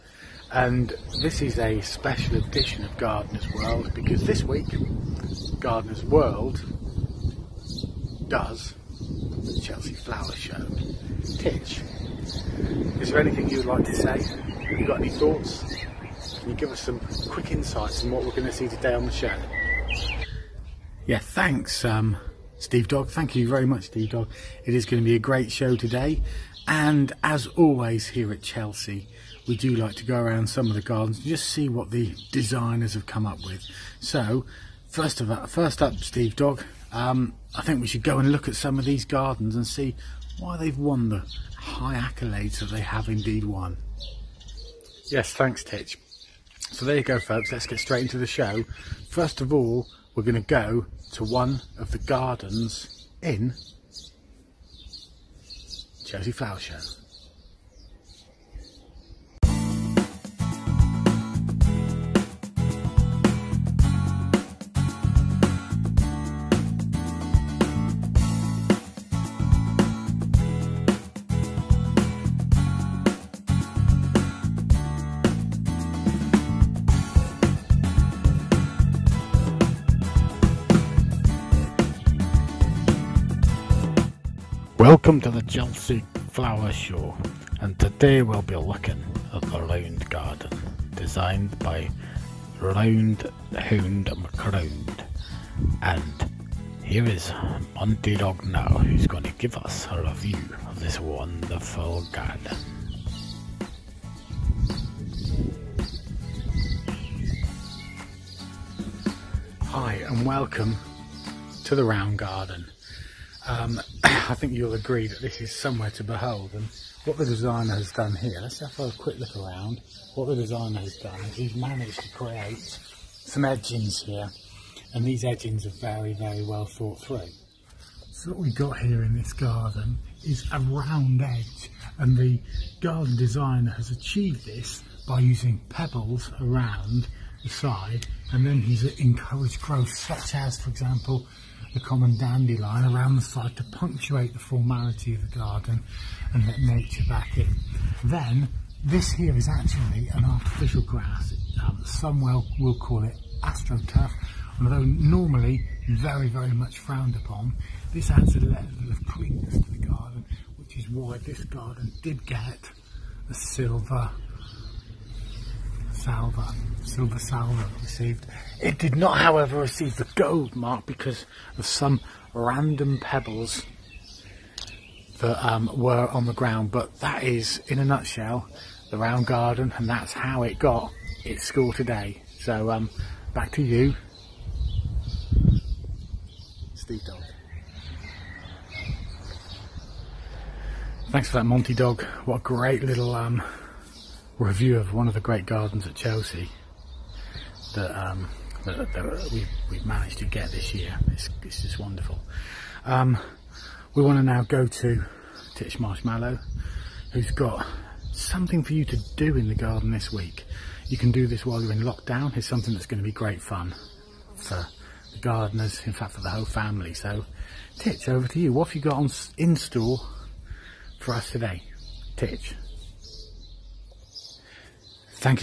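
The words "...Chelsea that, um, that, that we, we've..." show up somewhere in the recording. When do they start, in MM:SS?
03:15.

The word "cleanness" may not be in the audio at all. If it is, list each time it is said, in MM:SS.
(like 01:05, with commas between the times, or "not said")
02:39.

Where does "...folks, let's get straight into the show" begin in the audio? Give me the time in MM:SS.
00:47.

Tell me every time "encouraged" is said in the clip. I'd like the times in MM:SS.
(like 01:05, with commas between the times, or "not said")
02:18.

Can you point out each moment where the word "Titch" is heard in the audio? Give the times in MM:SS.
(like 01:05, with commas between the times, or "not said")
00:11, 00:45, 03:25, 03:37, 03:42.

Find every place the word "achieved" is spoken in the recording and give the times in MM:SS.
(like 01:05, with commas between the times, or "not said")
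02:13.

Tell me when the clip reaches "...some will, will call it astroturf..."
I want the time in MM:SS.
02:31.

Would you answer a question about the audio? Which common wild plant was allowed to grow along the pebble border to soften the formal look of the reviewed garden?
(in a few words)
Dandelion.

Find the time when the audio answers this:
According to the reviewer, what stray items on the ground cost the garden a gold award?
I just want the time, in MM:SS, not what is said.
02:52.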